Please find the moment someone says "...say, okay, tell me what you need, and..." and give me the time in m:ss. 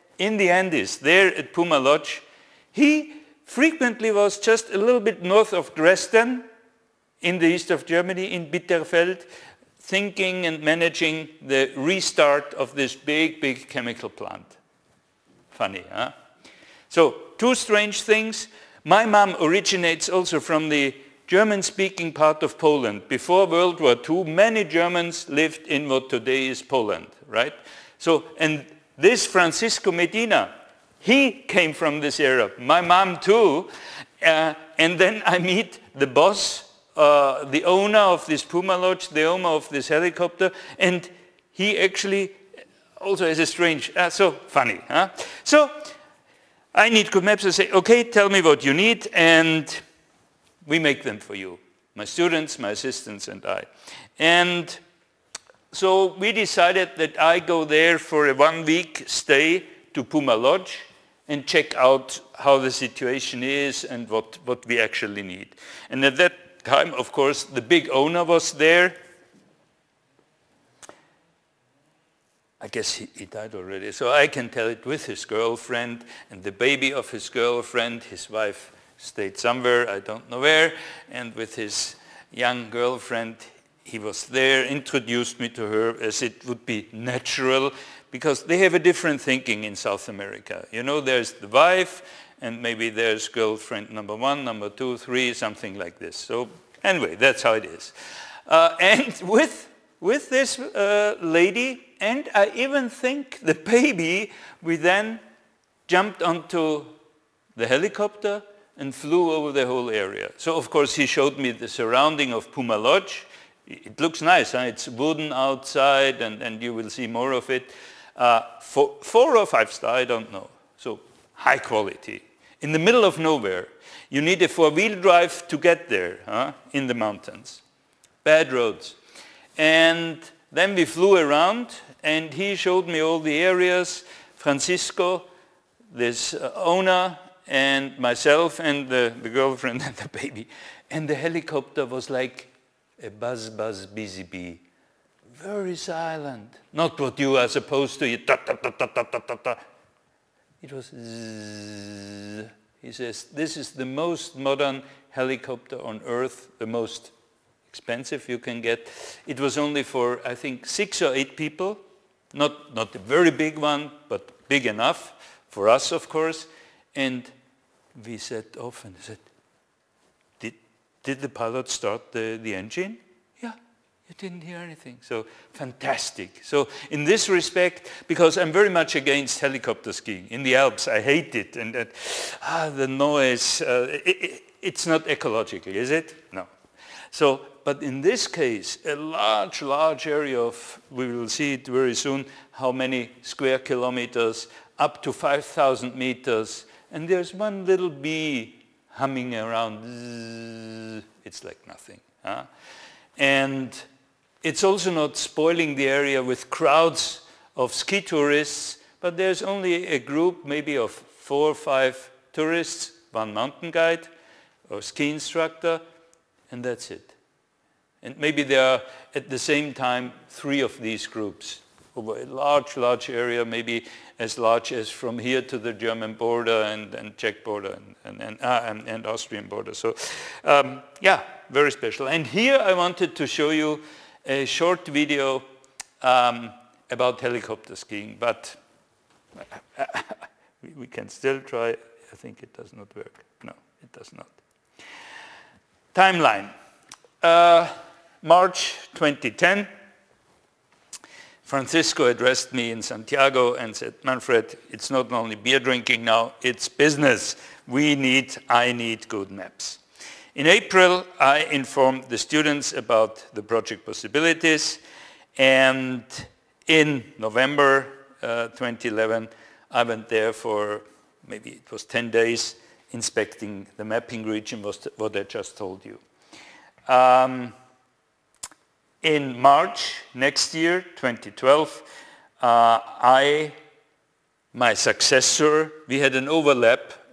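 0:47.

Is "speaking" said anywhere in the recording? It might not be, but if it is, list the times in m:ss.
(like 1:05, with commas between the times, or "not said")
0:21.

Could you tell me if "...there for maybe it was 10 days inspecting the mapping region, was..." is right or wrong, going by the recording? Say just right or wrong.
right.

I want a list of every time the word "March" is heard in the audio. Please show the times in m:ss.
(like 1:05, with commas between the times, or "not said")
4:08, 4:39.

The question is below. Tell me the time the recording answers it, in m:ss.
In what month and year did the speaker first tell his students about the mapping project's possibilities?
4:20.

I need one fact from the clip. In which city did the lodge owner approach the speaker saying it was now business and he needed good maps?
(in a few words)
Santiago.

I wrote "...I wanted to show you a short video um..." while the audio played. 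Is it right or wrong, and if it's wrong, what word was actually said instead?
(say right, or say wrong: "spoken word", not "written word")
right.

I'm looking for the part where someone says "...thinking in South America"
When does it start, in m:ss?
1:29.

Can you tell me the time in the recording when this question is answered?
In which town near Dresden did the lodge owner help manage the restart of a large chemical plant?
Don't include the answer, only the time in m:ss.
0:08.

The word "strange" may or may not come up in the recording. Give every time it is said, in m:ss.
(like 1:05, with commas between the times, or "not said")
0:17, 0:43.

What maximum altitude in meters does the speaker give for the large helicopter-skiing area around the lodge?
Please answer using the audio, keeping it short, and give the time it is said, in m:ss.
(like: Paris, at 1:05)
5,000 meters, at 3:15.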